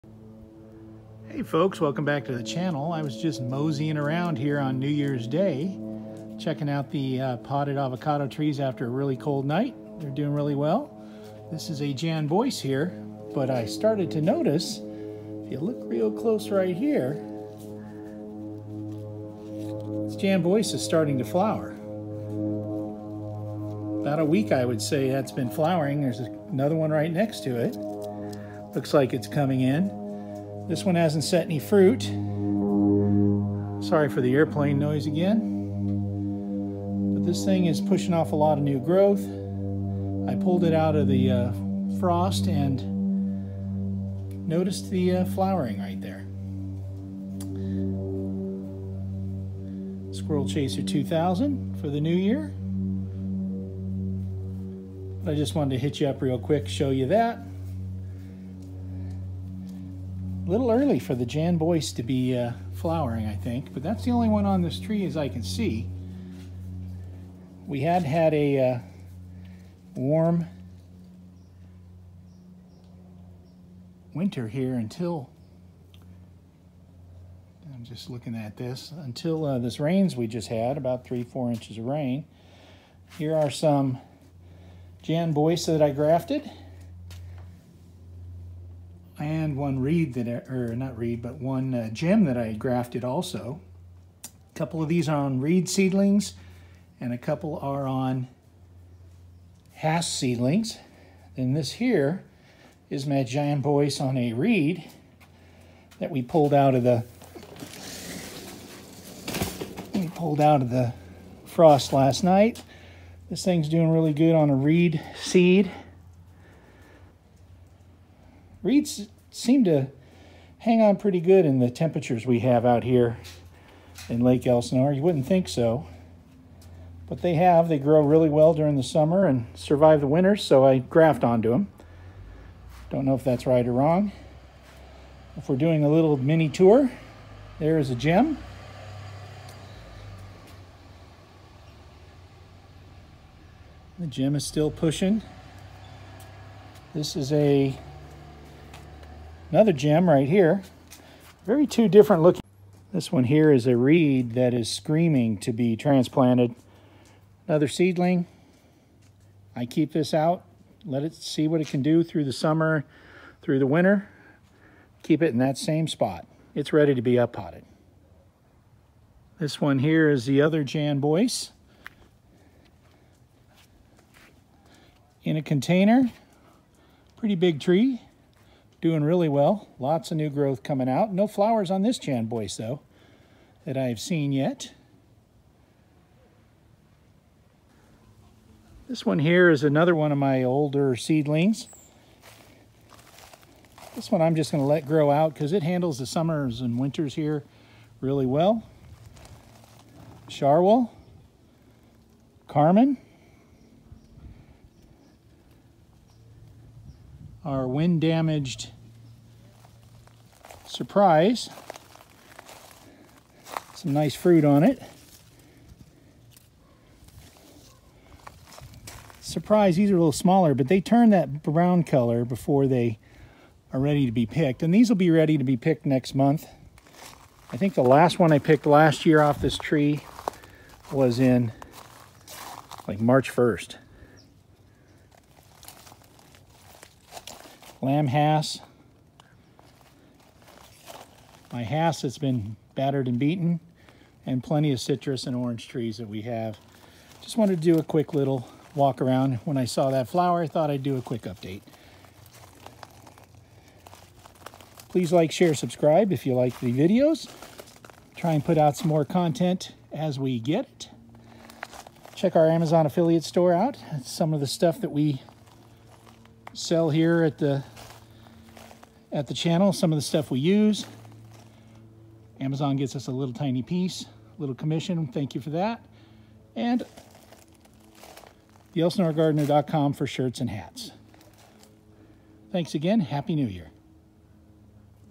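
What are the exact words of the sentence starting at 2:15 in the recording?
If we're doing a little mini tour, there is a gem.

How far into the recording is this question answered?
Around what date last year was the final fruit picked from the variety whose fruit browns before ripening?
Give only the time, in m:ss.
3:52.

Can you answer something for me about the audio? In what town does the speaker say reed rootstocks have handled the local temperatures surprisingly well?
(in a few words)
Lake Elsinore.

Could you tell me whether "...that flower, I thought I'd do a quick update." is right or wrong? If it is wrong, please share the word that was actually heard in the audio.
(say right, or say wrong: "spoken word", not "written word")
right.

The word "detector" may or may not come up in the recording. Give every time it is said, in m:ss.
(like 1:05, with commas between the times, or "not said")
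not said.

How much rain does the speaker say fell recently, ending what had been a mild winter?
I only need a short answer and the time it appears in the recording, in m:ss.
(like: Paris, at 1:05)
3 to 4 inches, at 1:20.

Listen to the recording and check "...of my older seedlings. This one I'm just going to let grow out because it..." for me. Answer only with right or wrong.
right.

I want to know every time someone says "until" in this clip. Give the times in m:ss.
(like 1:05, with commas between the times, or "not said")
1:14, 1:19.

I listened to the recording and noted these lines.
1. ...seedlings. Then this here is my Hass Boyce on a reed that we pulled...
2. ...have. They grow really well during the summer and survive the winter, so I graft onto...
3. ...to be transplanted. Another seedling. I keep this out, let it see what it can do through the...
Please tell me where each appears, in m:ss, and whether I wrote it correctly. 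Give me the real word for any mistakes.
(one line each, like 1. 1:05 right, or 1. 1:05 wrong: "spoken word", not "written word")
1. 1:40 wrong: "Jan", not "Hass"
2. 2:07 right
3. 2:35 right.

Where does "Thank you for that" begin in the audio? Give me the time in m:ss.
4:35.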